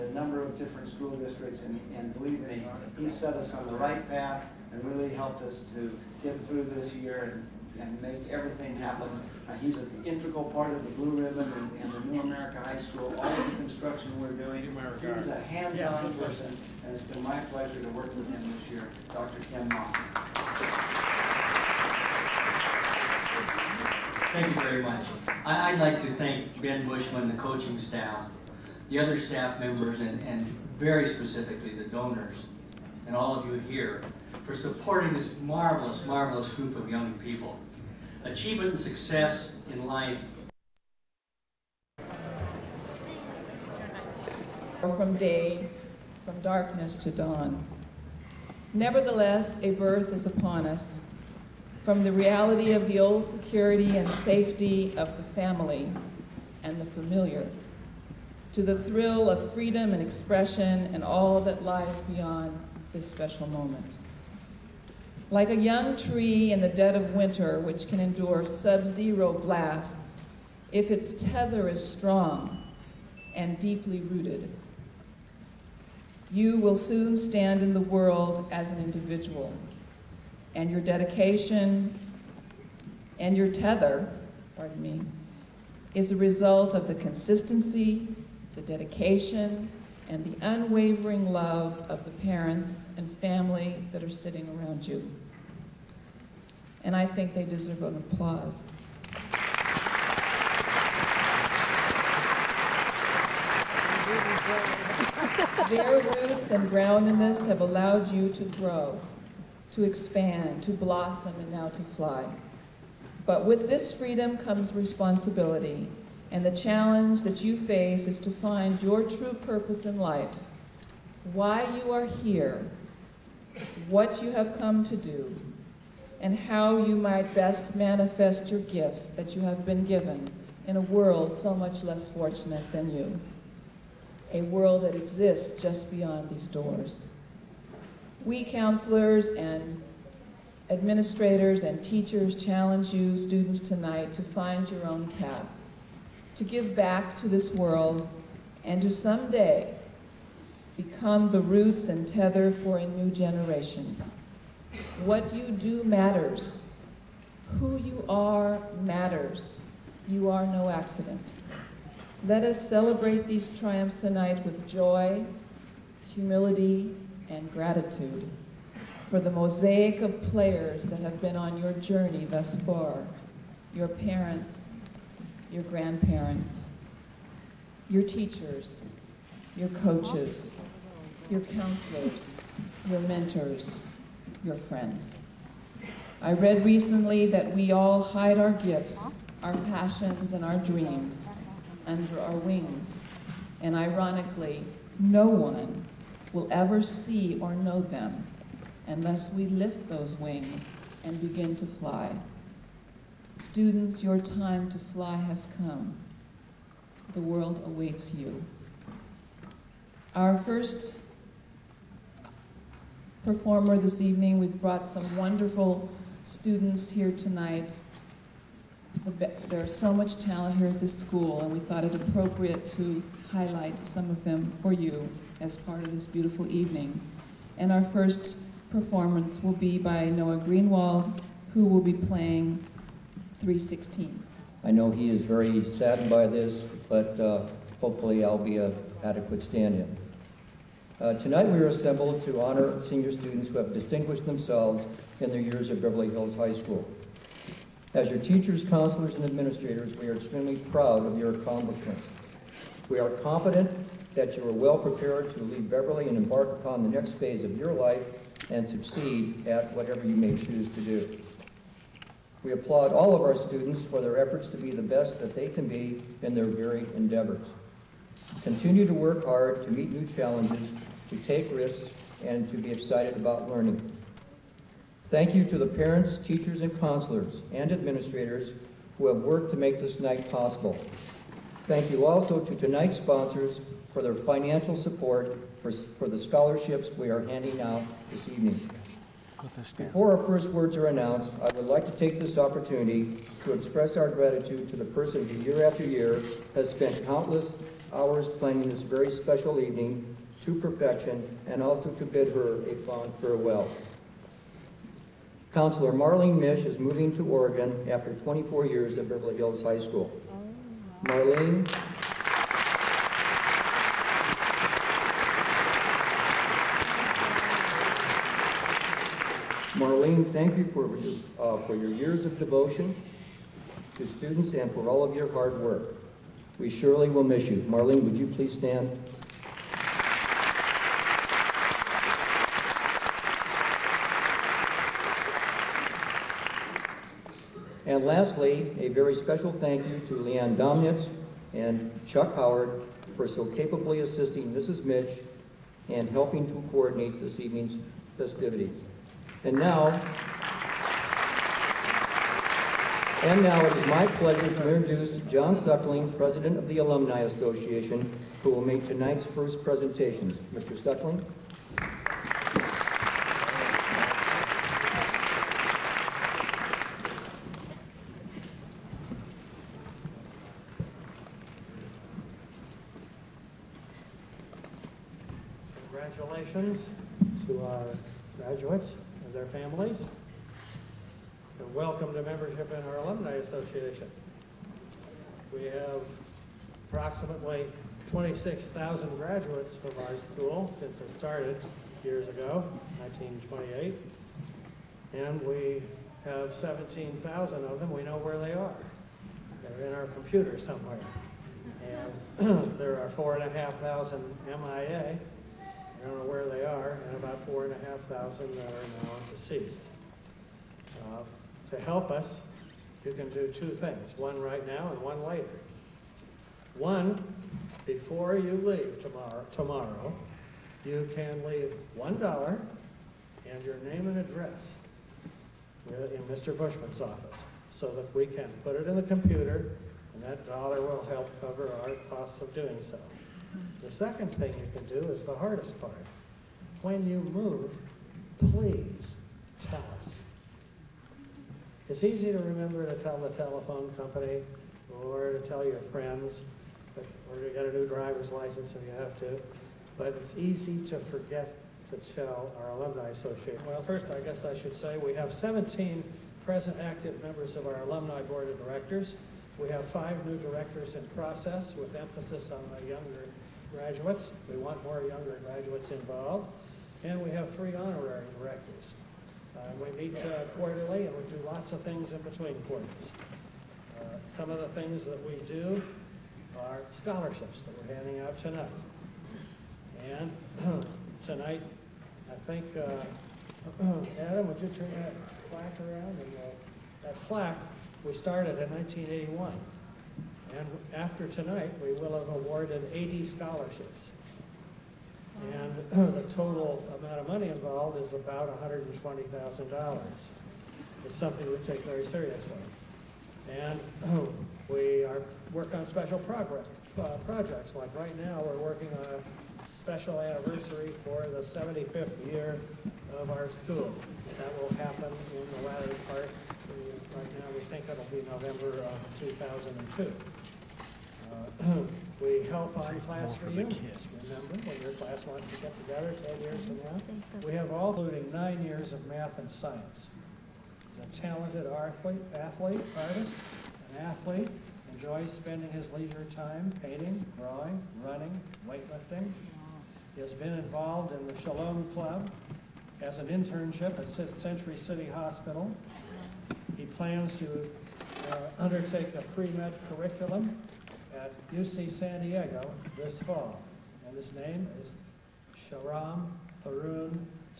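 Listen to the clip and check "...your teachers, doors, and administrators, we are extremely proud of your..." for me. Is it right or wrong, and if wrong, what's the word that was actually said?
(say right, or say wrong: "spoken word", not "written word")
wrong: "counselors", not "doors".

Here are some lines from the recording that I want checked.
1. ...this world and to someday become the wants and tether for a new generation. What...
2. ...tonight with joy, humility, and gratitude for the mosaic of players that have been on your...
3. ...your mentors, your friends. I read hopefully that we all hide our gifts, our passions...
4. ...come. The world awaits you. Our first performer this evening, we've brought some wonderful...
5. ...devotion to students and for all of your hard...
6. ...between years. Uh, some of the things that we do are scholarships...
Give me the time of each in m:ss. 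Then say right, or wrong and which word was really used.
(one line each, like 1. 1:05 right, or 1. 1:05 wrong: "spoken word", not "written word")
1. 2:27 wrong: "roots", not "wants"
2. 2:43 right
3. 3:02 wrong: "recently", not "hopefully"
4. 3:25 right
5. 5:22 right
6. 7:52 wrong: "quarters", not "years".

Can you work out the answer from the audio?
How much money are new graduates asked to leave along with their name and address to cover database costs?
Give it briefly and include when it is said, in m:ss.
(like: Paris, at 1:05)
$1, at 7:01.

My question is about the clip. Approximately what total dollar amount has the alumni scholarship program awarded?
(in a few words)
$120,000.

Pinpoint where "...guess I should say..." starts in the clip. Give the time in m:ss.
7:34.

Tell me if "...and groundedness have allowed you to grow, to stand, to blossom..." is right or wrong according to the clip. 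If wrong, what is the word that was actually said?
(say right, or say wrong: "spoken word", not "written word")
wrong: "expand", not "stand".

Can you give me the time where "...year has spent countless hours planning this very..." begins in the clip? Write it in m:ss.
4:55.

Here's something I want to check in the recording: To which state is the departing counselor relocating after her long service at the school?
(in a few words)
Oregon.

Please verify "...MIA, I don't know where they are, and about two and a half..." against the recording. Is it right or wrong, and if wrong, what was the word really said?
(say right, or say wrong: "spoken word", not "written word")
wrong: "four", not "two".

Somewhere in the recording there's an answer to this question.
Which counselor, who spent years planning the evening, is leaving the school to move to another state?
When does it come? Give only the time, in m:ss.
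5:05.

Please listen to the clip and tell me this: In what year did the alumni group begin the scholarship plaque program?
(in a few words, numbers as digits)
1981.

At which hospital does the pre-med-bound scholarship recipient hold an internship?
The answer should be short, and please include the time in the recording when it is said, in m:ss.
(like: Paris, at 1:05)
Century City Hospital, at 9:04.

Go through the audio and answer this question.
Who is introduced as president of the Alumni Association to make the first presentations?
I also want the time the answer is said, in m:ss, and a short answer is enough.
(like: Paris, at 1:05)
John Suckling, at 5:55.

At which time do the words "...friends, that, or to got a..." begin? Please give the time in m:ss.
7:25.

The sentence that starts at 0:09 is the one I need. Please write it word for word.
Uh, he's an integral part of the Blue Ribbon and, and, the New America High School, all the construction we're doing.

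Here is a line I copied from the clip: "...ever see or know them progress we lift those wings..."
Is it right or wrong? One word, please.
wrong.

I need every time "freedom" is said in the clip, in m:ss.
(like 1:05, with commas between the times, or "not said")
0:59, 1:53.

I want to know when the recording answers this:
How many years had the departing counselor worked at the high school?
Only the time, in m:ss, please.
5:08.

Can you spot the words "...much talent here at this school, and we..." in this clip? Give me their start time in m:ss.
3:39.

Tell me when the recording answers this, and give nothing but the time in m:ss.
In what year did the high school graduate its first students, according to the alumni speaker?
6:33.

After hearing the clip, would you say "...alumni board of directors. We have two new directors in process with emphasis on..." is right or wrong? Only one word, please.
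wrong.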